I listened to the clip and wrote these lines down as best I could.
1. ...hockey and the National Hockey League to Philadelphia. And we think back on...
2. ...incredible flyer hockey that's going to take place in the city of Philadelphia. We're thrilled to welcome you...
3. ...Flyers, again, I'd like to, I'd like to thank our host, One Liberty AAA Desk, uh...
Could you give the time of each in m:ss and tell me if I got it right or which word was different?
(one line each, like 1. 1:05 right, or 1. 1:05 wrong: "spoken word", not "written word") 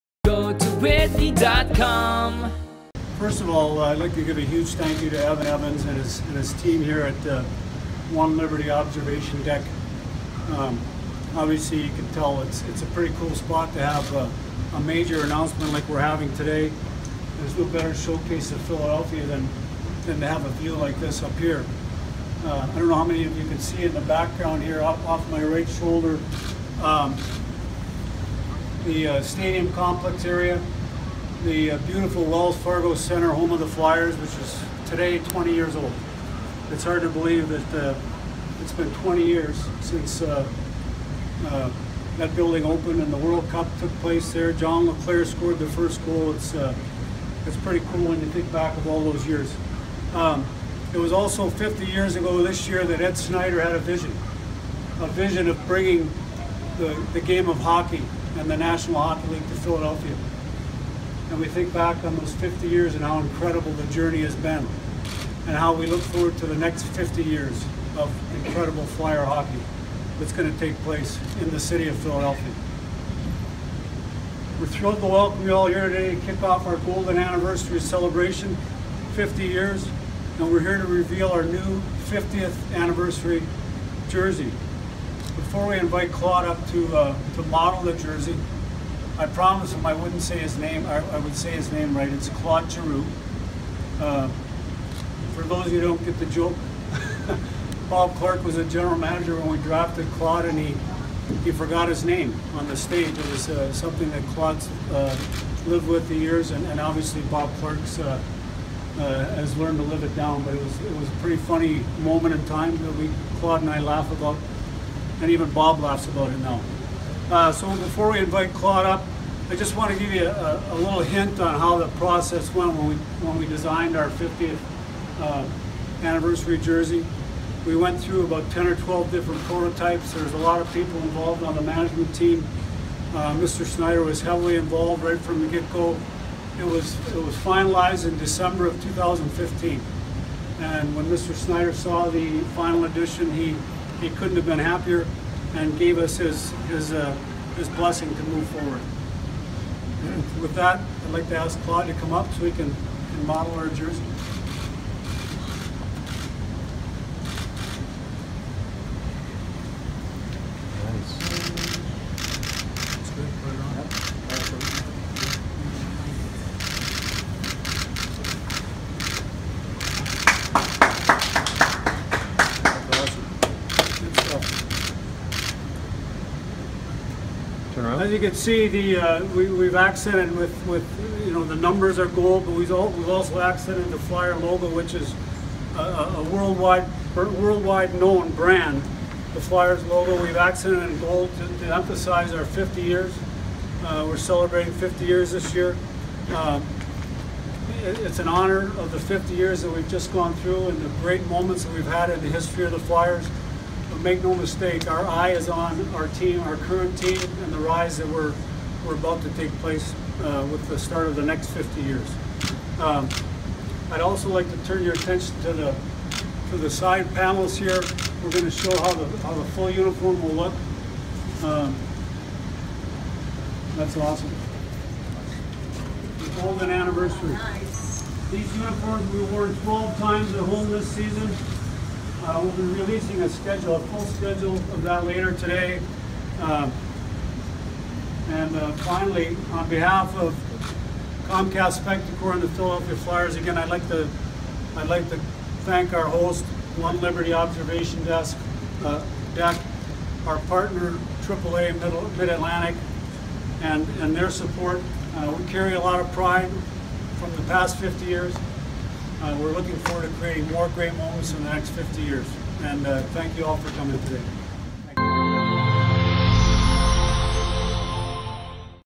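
1. 0:57 right
2. 1:08 right
3. 4:02 wrong: "Observation", not "AAA".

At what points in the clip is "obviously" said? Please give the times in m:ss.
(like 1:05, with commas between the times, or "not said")
0:11, 1:46.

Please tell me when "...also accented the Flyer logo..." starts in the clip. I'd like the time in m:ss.
3:02.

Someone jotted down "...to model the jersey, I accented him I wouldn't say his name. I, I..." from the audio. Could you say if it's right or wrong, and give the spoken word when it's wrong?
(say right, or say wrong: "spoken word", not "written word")
wrong: "promised", not "accented".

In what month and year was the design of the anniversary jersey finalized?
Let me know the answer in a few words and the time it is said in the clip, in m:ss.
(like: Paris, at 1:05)
December 2015, at 2:18.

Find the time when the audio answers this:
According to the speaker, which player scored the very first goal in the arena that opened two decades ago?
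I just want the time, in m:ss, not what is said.
0:44.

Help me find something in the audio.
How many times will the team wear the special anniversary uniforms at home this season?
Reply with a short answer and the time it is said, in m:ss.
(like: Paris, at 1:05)
12, at 3:49.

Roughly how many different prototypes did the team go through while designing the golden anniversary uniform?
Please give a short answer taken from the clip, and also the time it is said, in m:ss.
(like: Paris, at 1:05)
10 or 12, at 2:08.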